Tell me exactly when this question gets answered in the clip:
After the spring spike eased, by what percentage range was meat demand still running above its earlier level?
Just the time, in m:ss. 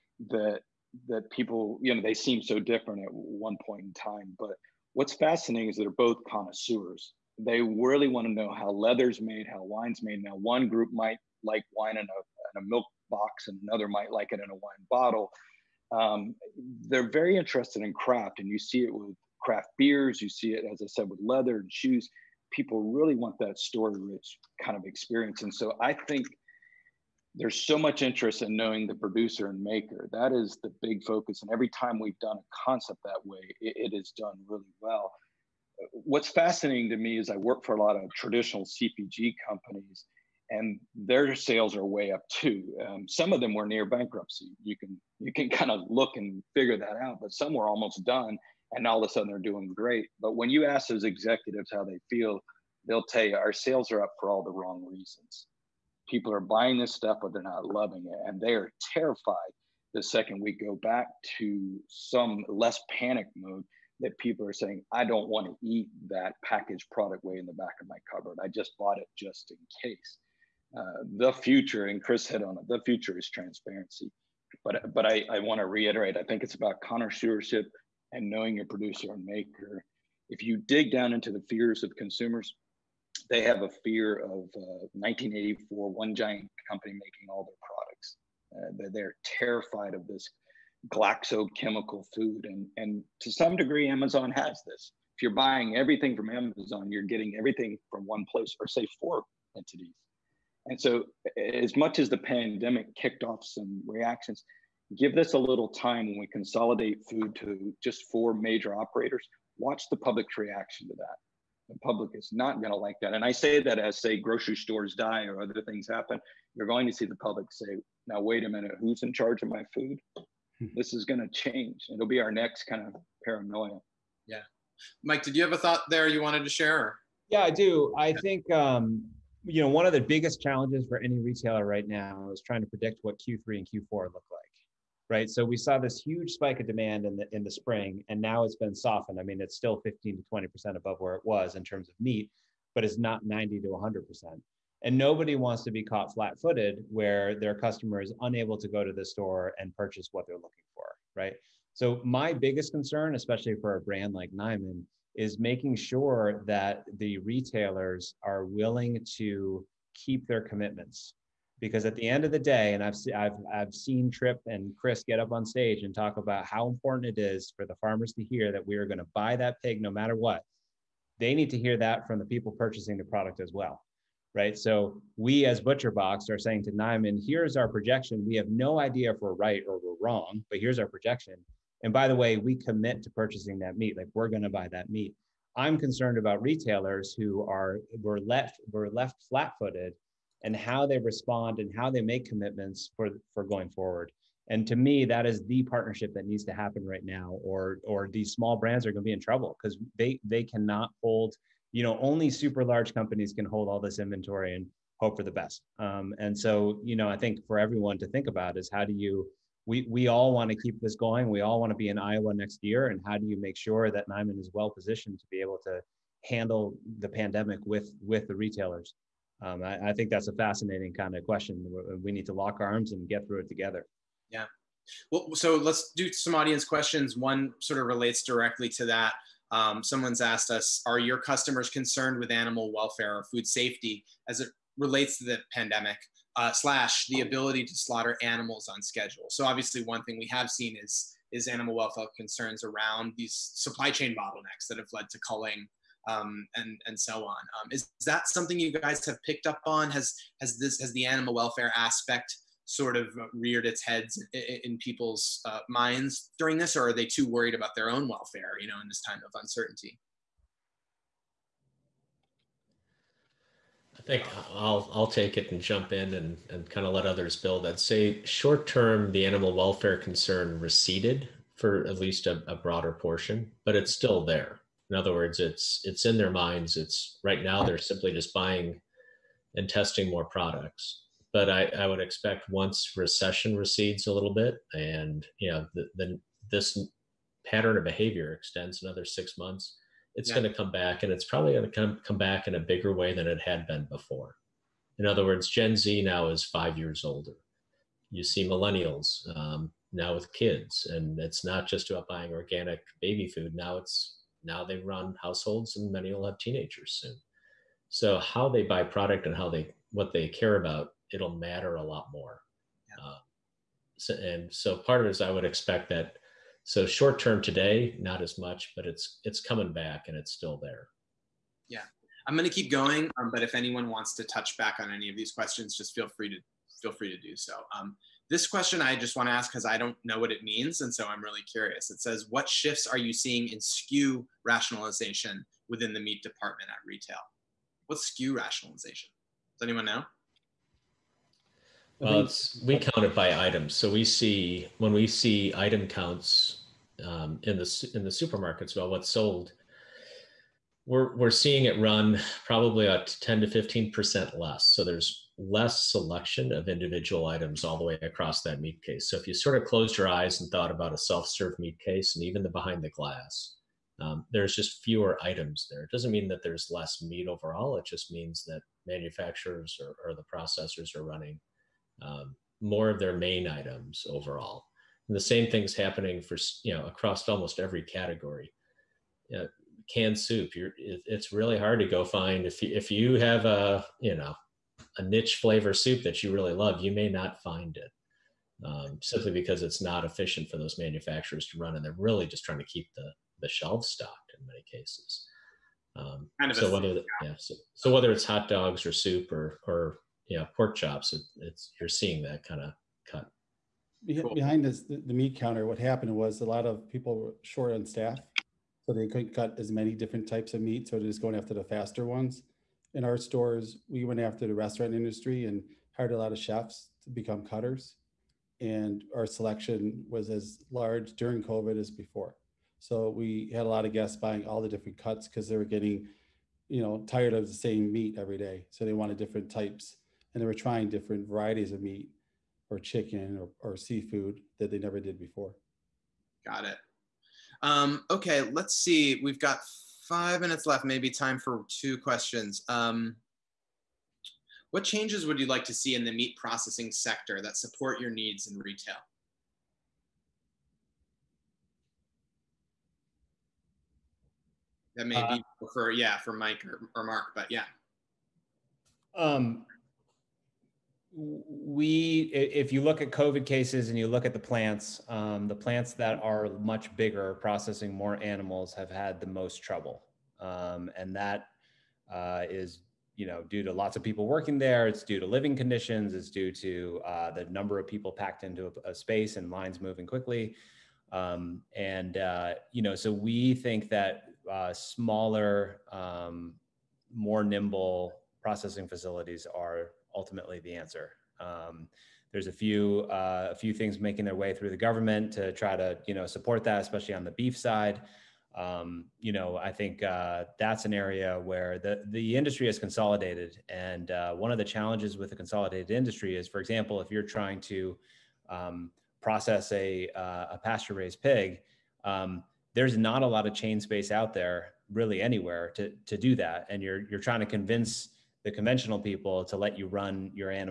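2:19.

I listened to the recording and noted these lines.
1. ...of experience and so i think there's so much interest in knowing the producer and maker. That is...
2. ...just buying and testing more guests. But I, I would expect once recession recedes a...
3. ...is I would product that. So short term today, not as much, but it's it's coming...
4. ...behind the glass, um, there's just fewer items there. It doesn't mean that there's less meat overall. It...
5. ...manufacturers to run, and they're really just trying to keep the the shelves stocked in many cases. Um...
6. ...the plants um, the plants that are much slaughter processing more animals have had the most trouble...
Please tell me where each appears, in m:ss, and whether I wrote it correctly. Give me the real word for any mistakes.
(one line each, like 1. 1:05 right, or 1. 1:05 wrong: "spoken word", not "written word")
1. 0:24 right
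2. 4:38 wrong: "products", not "guests"
3. 5:15 wrong: "expect", not "product"
4. 6:02 right
5. 6:30 right
6. 7:44 wrong: "bigger", not "slaughter".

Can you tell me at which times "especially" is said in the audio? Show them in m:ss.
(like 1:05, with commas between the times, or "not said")
2:33, 8:16.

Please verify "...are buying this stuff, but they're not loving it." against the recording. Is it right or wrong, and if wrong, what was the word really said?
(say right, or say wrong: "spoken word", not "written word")
right.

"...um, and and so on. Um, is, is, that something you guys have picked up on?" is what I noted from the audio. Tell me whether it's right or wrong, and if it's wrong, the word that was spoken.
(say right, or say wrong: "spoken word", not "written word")
right.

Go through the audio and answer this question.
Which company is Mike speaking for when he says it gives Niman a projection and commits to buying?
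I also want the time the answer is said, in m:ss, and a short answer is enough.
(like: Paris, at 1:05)
ButcherBox, at 2:55.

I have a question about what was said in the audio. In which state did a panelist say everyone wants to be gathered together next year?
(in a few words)
Iowa.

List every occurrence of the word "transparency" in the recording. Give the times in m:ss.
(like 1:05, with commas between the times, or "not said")
1:13.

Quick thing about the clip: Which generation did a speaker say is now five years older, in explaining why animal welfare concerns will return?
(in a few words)
Gen Z.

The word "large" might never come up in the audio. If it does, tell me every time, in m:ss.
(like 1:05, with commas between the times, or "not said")
3:22, 7:00.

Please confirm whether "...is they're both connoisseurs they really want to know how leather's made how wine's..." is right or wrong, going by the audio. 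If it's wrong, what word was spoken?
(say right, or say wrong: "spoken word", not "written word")
right.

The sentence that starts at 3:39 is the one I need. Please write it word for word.
um, I, I, think that's a fascinating kind of question.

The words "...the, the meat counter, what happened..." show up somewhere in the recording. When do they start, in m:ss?
6:44.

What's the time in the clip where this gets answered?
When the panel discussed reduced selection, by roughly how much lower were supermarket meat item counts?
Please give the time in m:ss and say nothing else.
5:53.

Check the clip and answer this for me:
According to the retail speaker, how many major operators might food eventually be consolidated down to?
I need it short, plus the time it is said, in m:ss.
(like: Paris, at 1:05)
4, at 1:48.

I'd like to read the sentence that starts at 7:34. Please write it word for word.
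That may uh, be for, yeah, for Mike or, or Marc, but yeah.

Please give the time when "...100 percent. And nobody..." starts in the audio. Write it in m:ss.
2:23.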